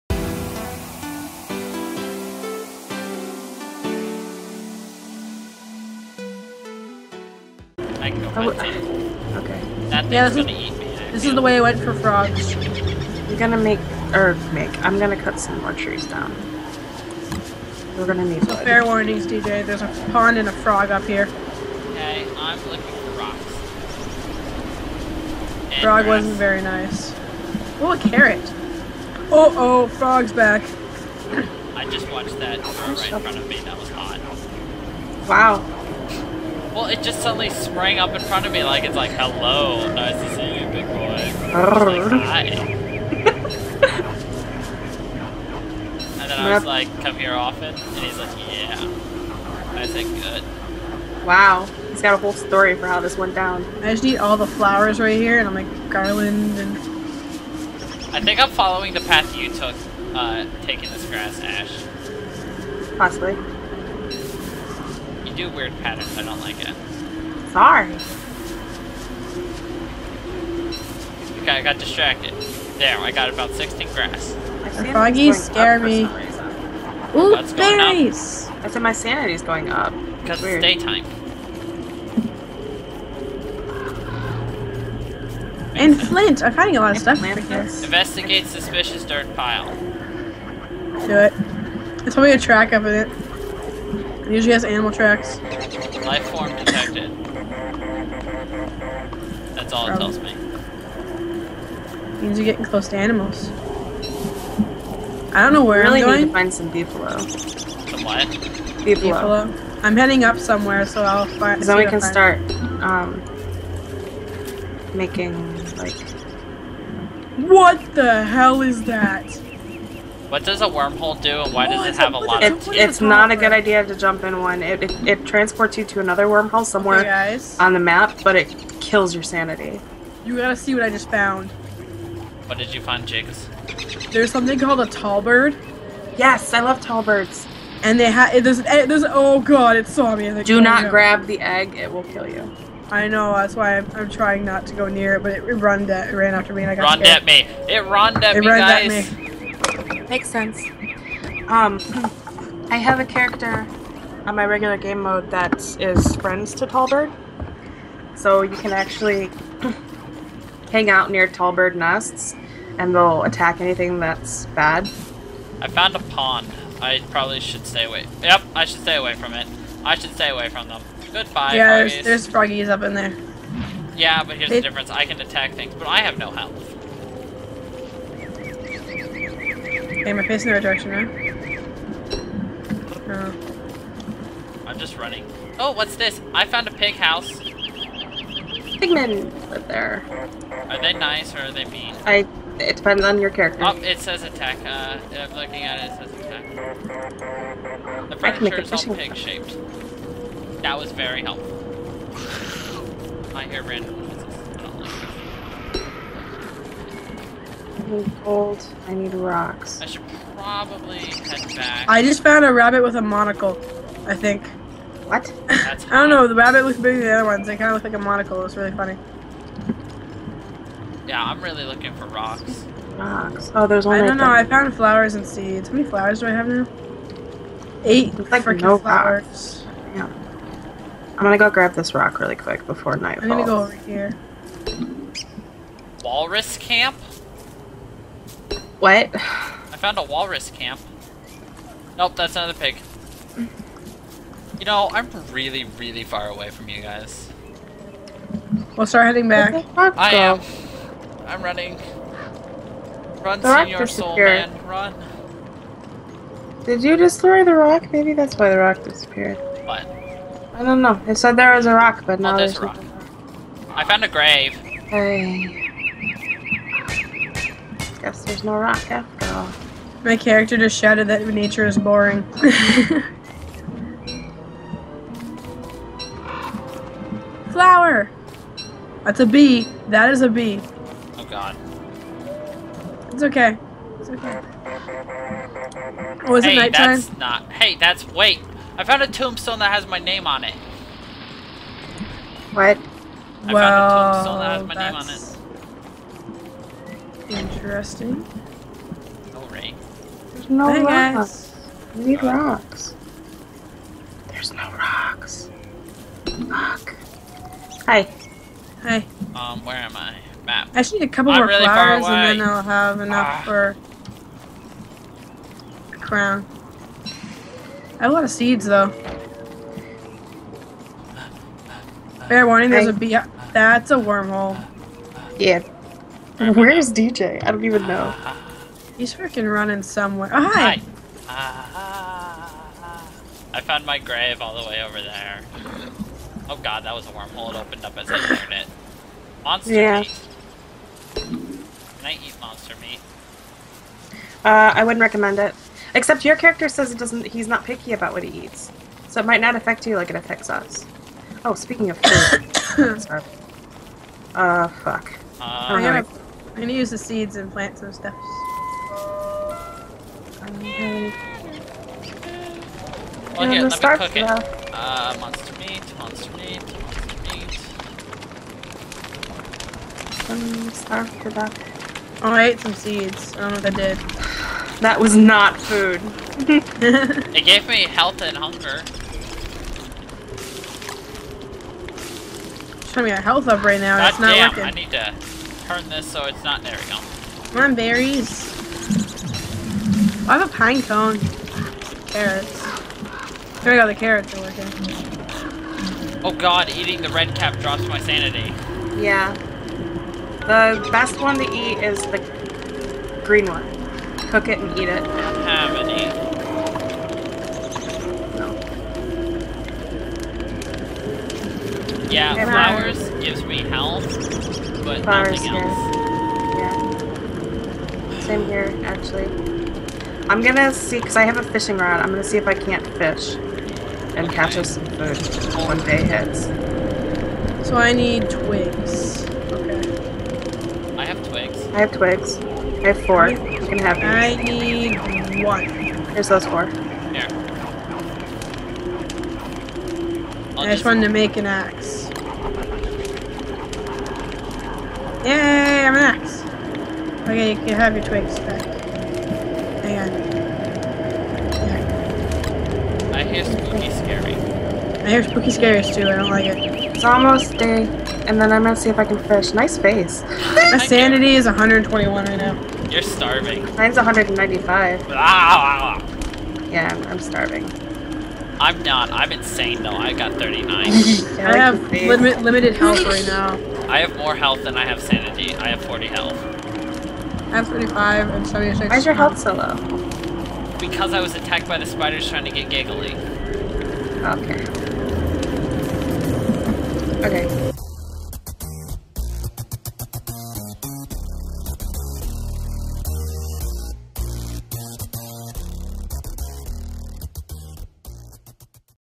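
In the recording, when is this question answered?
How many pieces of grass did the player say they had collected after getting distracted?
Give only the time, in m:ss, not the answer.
1:13.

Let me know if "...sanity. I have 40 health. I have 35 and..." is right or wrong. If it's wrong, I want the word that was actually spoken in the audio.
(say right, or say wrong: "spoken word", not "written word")
right.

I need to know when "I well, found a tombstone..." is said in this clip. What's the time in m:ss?
4:53.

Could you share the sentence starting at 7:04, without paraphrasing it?
catch us some food when day hits.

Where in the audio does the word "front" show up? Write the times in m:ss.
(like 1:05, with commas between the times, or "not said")
0:33, 0:38.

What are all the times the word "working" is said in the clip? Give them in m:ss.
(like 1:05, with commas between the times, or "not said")
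6:24, 6:34.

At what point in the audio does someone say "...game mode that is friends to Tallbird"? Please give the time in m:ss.
2:34.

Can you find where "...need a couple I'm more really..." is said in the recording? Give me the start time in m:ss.
5:10.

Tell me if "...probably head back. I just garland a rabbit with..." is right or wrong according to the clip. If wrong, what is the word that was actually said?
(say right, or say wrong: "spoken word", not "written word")
wrong: "found", not "garland".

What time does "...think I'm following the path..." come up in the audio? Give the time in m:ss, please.
0:58.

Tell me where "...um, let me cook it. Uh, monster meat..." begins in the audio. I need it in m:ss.
6:03.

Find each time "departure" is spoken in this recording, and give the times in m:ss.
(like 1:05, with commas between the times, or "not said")
not said.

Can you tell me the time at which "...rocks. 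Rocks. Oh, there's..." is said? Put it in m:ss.
3:42.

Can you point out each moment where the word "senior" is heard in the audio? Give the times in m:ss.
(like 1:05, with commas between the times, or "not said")
4:13.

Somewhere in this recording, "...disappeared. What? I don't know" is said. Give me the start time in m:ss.
4:18.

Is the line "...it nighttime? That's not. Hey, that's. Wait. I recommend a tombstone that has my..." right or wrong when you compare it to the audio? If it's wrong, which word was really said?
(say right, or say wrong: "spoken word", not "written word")
wrong: "found", not "recommend".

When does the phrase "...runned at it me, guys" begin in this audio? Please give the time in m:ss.
2:27.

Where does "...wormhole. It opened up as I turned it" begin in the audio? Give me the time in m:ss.
5:37.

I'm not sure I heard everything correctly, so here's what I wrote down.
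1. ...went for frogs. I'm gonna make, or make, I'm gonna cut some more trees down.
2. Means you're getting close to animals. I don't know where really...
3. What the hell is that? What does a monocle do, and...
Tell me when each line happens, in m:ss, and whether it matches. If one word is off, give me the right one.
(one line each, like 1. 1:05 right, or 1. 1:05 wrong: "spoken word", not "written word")
1. 0:11 right
2. 1:42 right
3. 1:57 wrong: "wormhole", not "monocle".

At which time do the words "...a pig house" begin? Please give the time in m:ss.
3:06.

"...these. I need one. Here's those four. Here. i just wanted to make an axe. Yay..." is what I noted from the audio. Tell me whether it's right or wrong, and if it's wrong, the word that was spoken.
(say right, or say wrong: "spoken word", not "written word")
right.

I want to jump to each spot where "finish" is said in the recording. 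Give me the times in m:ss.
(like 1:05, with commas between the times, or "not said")
7:39.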